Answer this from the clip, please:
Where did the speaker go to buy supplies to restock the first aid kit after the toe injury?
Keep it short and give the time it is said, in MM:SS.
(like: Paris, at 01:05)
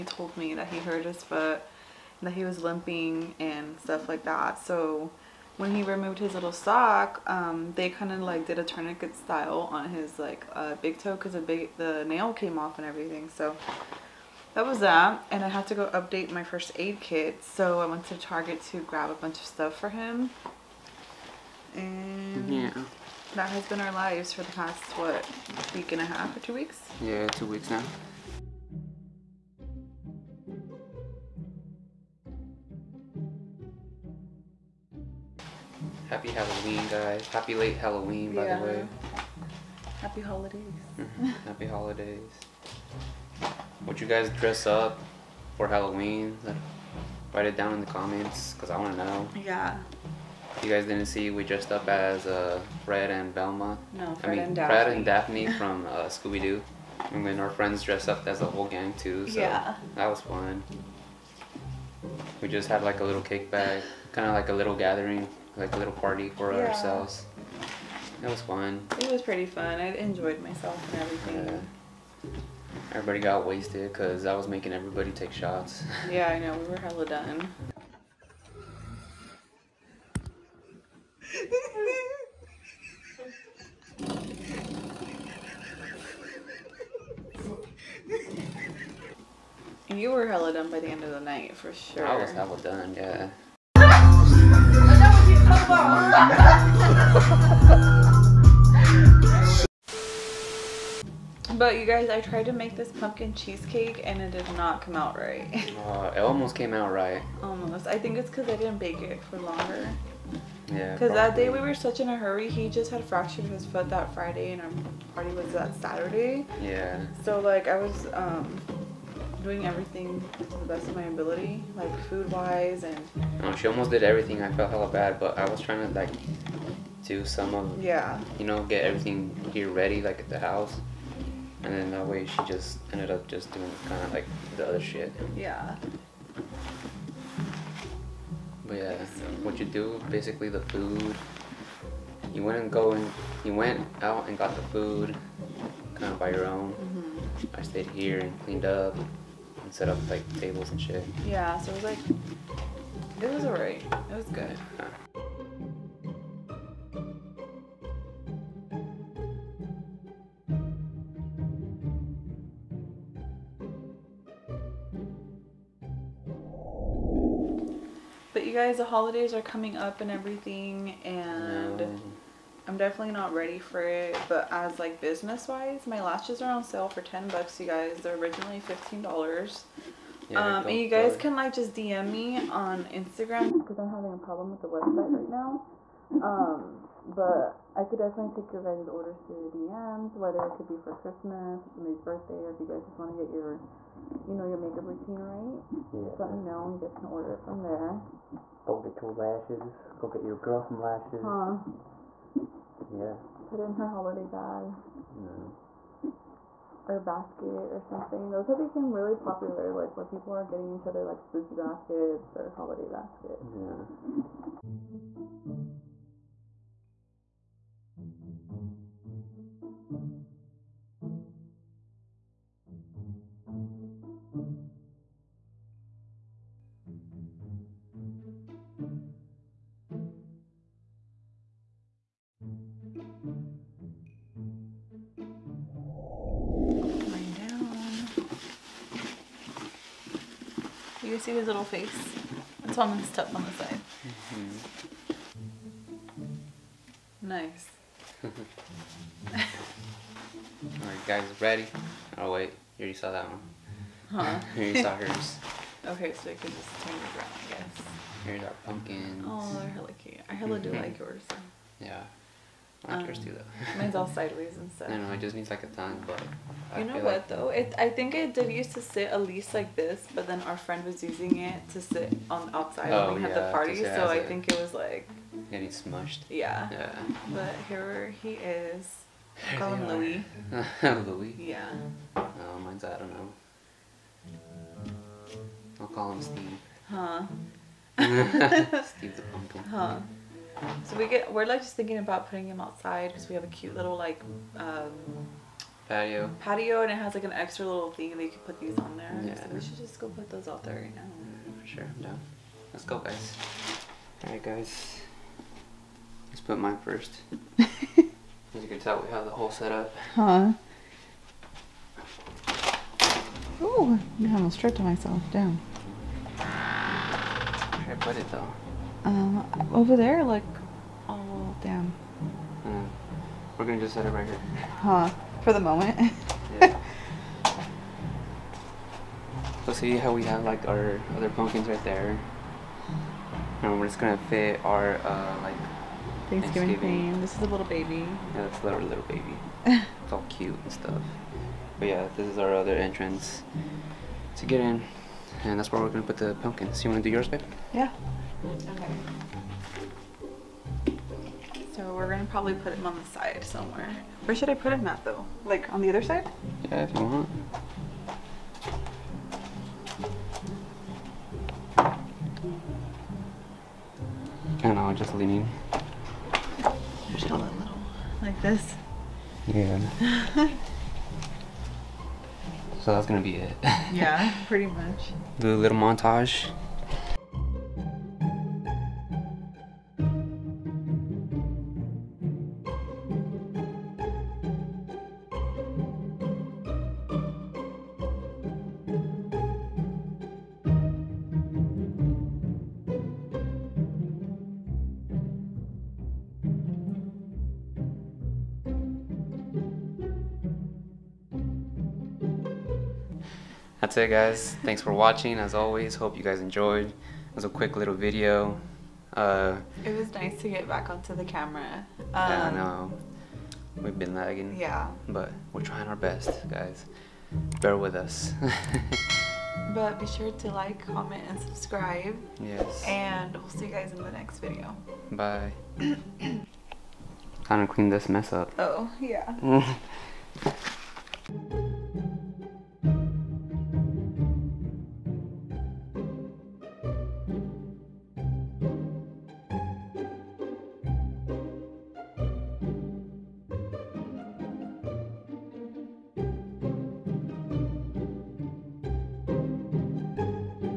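Target, at 00:18.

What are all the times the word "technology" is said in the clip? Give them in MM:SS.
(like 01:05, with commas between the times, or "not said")
not said.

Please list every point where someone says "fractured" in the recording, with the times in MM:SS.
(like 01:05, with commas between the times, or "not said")
01:53.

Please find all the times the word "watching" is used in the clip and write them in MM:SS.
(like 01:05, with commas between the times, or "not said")
06:44.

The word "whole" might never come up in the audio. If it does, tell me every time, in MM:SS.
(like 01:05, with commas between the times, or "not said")
00:58, 05:09.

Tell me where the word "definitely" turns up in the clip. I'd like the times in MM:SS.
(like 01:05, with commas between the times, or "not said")
02:52, 03:07.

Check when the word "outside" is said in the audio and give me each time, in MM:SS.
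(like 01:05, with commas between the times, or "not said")
04:32, 04:52.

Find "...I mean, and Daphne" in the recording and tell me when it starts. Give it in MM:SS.
00:54.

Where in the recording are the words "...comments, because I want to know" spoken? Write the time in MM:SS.
00:47.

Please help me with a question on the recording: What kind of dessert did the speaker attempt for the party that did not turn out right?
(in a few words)
pumpkin cheesecake.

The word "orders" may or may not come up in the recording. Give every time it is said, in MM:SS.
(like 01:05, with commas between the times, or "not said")
03:08, 03:17.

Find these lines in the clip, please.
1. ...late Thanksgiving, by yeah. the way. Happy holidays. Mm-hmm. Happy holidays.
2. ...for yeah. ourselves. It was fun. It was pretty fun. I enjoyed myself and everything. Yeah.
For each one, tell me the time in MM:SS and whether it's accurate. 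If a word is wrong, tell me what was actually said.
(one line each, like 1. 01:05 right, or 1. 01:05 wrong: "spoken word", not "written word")
1. 00:37 wrong: "Halloween", not "Thanksgiving"
2. 01:06 right.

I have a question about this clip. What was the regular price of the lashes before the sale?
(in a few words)
$15.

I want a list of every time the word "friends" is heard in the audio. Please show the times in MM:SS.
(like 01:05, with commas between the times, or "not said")
00:57, 04:30.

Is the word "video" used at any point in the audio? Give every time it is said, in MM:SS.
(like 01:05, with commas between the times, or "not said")
06:47, 07:04.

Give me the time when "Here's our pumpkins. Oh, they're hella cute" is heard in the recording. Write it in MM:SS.
04:18.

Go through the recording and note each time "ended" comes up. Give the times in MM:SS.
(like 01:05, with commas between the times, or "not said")
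02:12.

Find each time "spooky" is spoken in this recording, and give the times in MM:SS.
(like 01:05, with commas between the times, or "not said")
03:31.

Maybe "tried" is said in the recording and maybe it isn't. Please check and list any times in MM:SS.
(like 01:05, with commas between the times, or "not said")
01:42.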